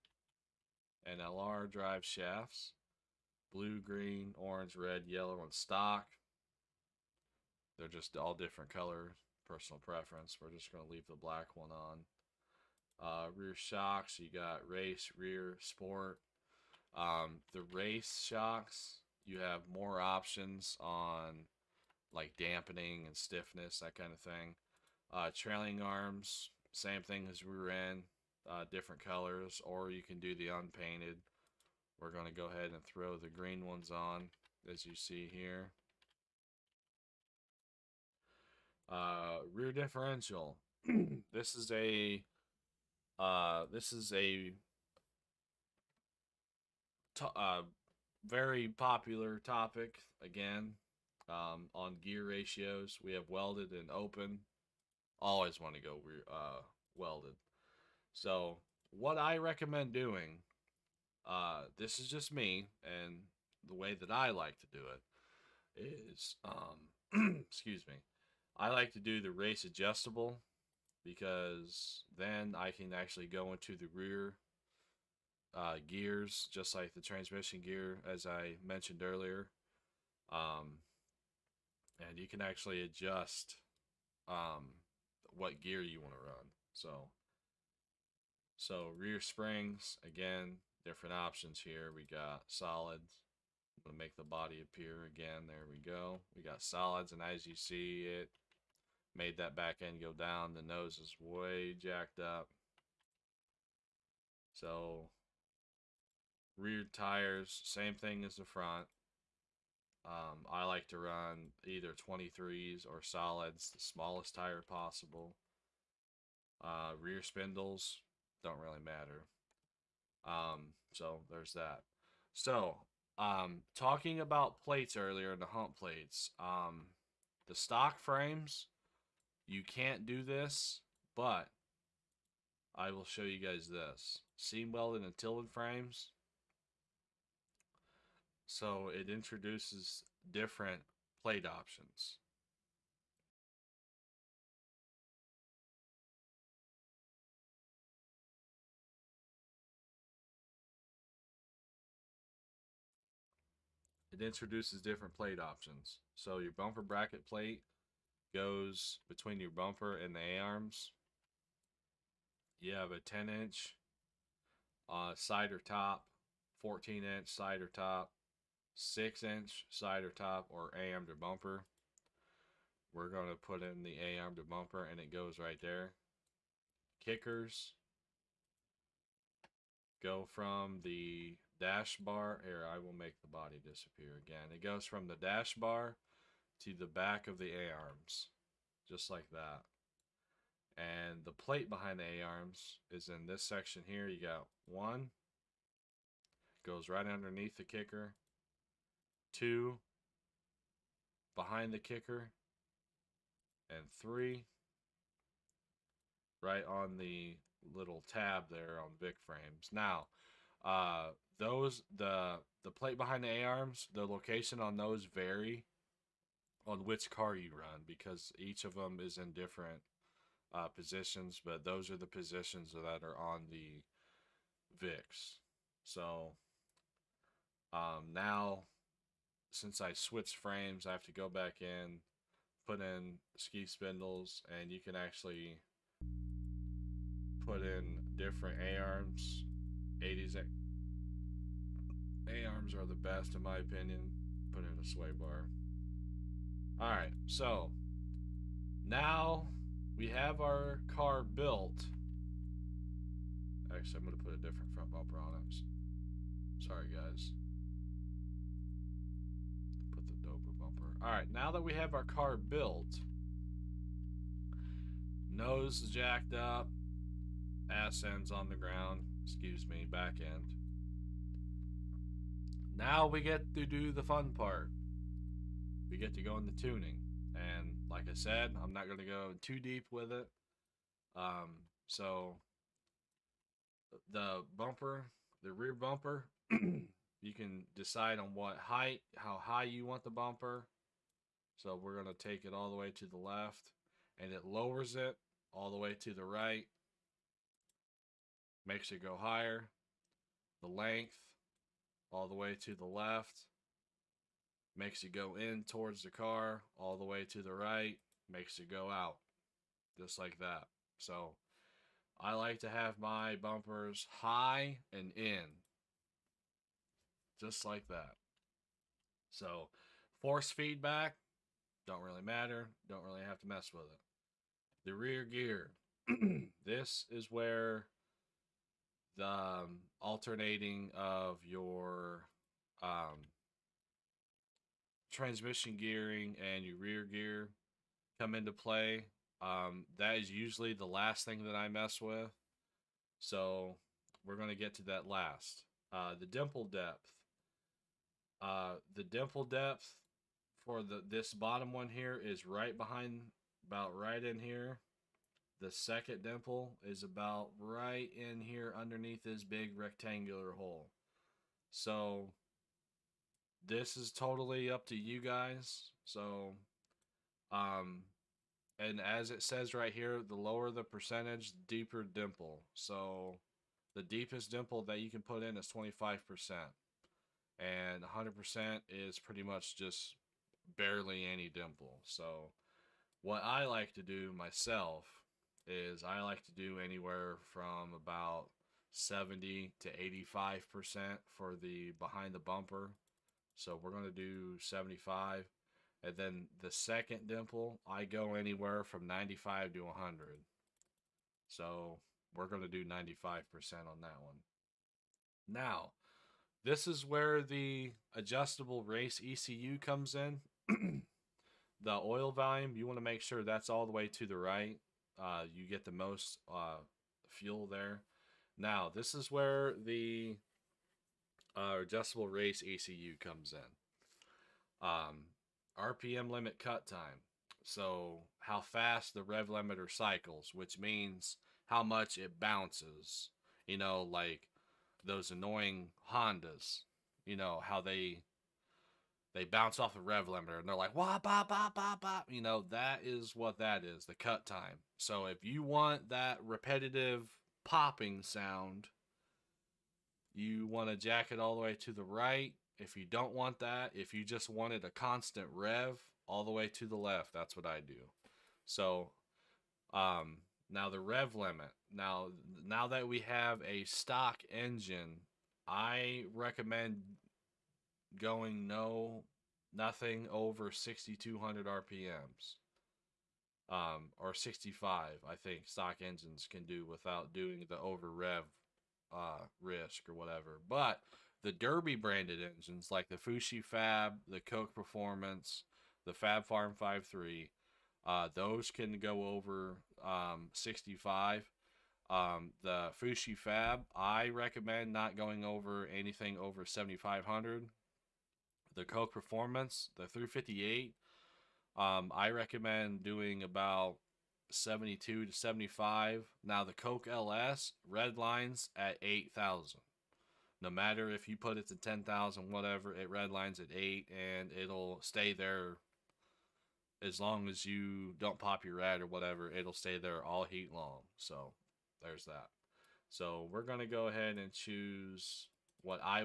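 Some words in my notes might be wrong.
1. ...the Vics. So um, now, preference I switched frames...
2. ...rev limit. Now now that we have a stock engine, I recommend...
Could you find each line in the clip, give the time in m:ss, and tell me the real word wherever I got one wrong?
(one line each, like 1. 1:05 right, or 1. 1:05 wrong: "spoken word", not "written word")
1. 3:43 wrong: "since", not "preference"
2. 7:41 right.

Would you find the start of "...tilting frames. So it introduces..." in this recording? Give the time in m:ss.
2:15.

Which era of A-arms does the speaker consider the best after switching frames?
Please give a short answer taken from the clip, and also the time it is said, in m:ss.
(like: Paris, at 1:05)
80s, at 4:00.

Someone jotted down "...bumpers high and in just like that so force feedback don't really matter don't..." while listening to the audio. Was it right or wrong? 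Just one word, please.
right.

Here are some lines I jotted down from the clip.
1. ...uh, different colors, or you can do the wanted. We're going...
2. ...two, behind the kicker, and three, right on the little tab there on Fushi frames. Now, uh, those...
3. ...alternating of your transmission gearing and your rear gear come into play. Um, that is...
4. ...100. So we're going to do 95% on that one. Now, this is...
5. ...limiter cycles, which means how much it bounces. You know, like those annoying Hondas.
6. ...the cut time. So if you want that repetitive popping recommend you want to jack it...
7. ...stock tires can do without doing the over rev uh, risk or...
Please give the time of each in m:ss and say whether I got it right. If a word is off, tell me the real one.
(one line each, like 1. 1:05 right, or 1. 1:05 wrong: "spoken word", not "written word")
1. 0:28 wrong: "unpainted", not "wanted"
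2. 3:19 wrong: "Vic", not "Fushi"
3. 5:30 right
4. 6:39 right
5. 7:09 right
6. 7:24 wrong: "sound", not "recommend"
7. 7:55 wrong: "engines", not "tires".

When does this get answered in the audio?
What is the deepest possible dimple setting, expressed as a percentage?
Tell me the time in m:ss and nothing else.
6:15.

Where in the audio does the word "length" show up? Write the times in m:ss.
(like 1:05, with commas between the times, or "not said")
5:00.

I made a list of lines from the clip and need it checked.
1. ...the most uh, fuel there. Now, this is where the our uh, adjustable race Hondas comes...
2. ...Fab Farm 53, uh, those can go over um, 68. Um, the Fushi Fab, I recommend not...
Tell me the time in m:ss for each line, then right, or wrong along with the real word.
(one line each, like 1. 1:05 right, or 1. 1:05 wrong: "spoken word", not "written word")
1. 6:55 wrong: "ECU", not "Hondas"
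2. 8:06 wrong: "65", not "68".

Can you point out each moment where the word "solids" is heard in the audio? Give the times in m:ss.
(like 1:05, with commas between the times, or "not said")
1:32, 1:36, 1:53.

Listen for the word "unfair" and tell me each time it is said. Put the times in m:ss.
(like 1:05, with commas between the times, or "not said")
not said.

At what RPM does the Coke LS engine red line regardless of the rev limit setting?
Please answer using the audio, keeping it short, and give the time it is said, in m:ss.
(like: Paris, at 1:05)
8,000, at 8:29.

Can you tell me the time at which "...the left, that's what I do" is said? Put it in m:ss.
7:36.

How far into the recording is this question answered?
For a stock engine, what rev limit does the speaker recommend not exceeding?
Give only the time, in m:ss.
7:50.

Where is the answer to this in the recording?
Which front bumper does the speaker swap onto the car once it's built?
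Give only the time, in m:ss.
4:20.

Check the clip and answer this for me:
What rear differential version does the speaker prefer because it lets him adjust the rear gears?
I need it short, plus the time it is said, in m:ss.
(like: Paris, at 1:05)
Race adjustable, at 1:09.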